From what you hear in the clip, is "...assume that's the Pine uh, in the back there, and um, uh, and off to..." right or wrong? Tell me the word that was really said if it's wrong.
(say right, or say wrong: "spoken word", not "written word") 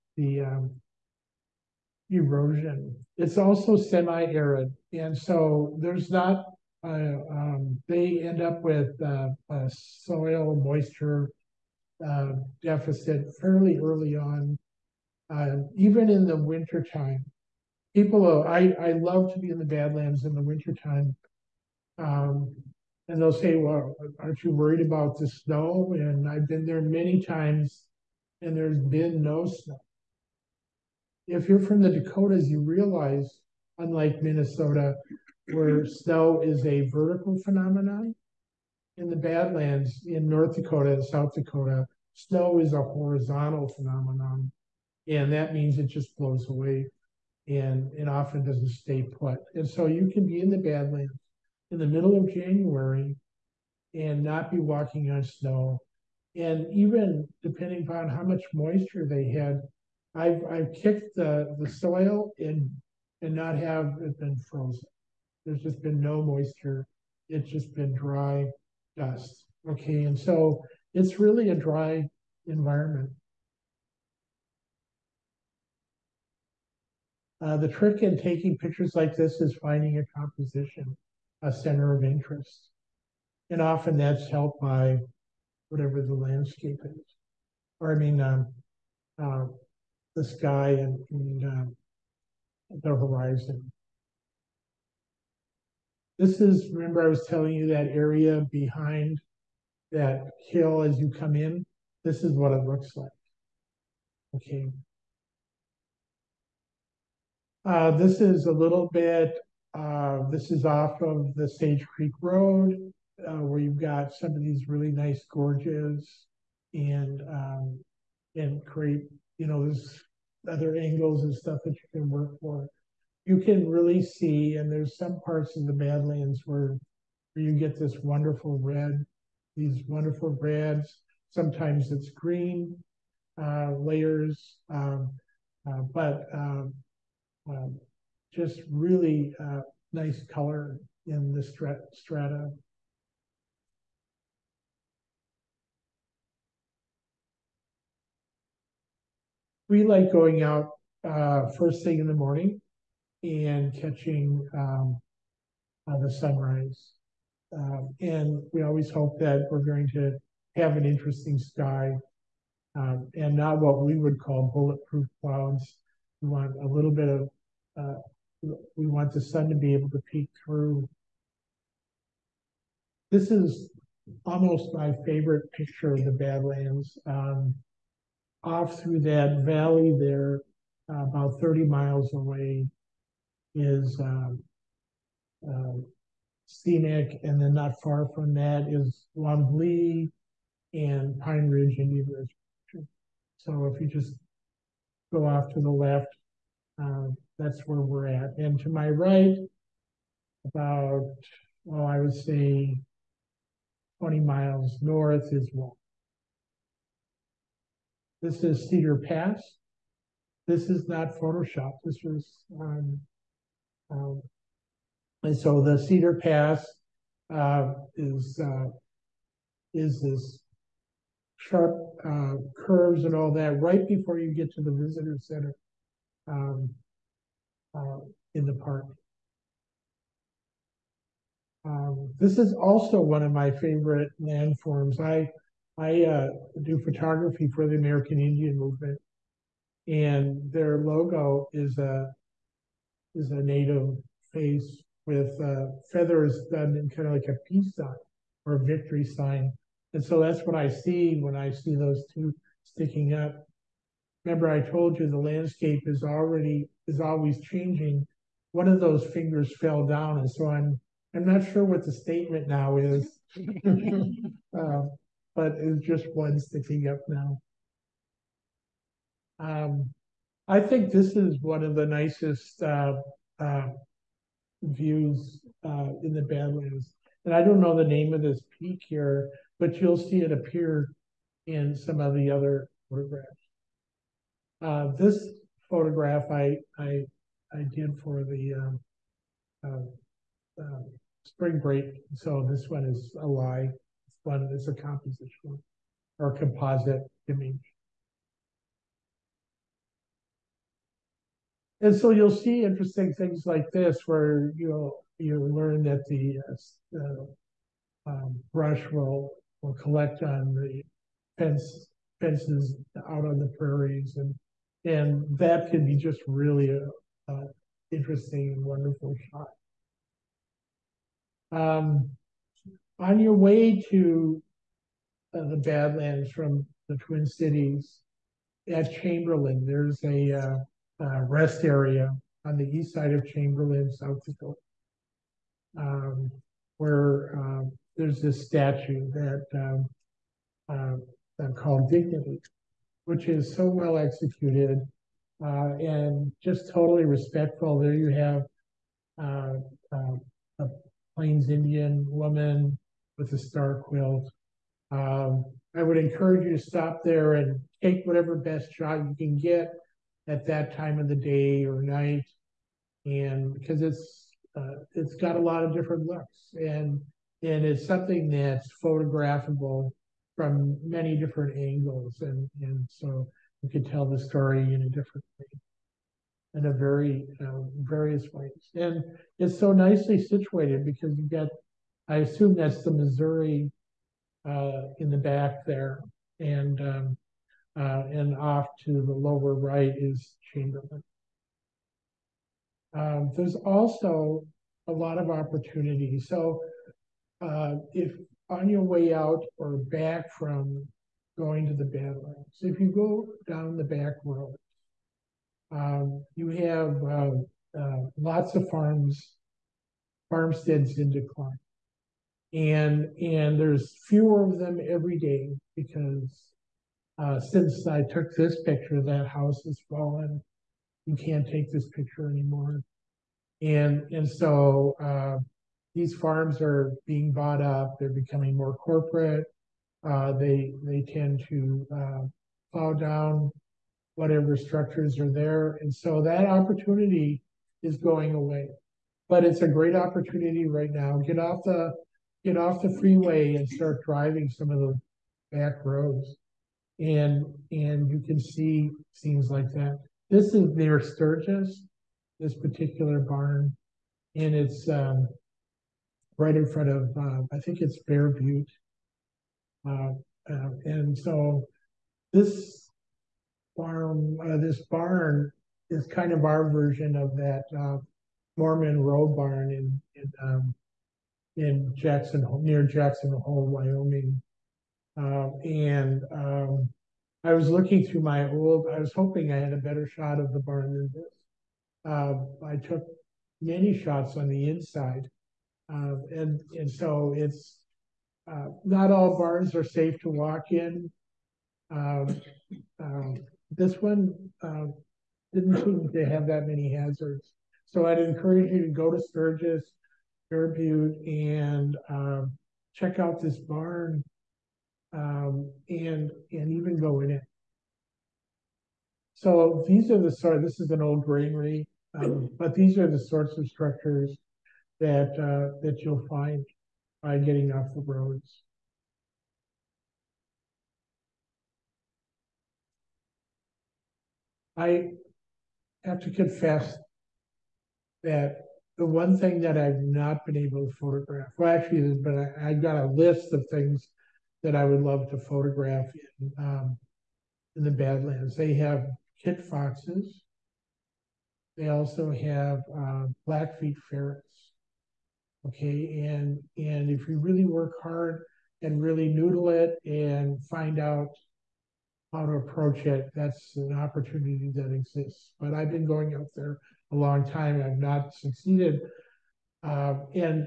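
wrong: "Missouri", not "Pine".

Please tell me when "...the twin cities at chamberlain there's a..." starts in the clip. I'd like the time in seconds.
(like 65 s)
326 s.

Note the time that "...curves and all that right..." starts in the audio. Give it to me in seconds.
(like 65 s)
222 s.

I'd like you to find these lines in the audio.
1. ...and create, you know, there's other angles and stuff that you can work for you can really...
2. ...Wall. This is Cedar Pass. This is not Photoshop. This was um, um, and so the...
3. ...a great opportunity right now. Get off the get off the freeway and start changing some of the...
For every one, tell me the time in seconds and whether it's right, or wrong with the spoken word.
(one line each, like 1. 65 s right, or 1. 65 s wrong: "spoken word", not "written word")
1. 118 s right
2. 205 s right
3. 439 s wrong: "driving", not "changing".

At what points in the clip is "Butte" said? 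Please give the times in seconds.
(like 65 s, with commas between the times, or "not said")
458 s, 500 s.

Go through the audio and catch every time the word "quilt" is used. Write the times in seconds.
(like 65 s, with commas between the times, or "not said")
353 s.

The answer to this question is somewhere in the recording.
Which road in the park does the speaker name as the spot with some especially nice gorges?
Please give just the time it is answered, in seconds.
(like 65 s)
111 s.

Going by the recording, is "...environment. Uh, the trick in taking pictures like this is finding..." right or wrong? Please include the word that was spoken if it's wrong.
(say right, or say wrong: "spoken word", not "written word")
right.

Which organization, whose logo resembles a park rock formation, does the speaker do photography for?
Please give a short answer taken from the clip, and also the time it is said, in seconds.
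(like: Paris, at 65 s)
American Indian Movement, at 237 s.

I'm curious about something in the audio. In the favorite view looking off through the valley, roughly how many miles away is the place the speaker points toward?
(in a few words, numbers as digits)
30 miles.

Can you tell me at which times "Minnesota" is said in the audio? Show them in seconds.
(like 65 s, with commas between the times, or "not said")
34 s.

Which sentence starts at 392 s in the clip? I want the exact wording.
Um, there's also a lot of opportunity.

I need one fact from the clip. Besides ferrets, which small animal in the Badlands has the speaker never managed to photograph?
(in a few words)
Kit foxes.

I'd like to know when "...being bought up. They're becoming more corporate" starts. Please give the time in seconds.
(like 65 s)
427 s.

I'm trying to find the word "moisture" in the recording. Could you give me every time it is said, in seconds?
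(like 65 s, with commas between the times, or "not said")
10 s, 58 s, 66 s.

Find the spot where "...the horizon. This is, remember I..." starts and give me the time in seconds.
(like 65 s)
92 s.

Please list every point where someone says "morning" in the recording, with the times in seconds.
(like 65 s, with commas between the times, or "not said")
152 s.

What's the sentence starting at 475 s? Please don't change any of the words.
Um, and um, I was looking through my old, I was hoping I had a better shot of the barn than this.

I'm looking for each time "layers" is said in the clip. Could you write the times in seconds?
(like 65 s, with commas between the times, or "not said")
133 s.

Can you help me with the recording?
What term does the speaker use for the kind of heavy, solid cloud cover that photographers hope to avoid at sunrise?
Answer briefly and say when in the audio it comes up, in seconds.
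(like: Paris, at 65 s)
Bulletproof clouds, at 164 s.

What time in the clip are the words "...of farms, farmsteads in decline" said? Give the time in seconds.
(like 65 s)
408 s.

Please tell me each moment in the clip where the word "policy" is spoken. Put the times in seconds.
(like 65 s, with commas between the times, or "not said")
not said.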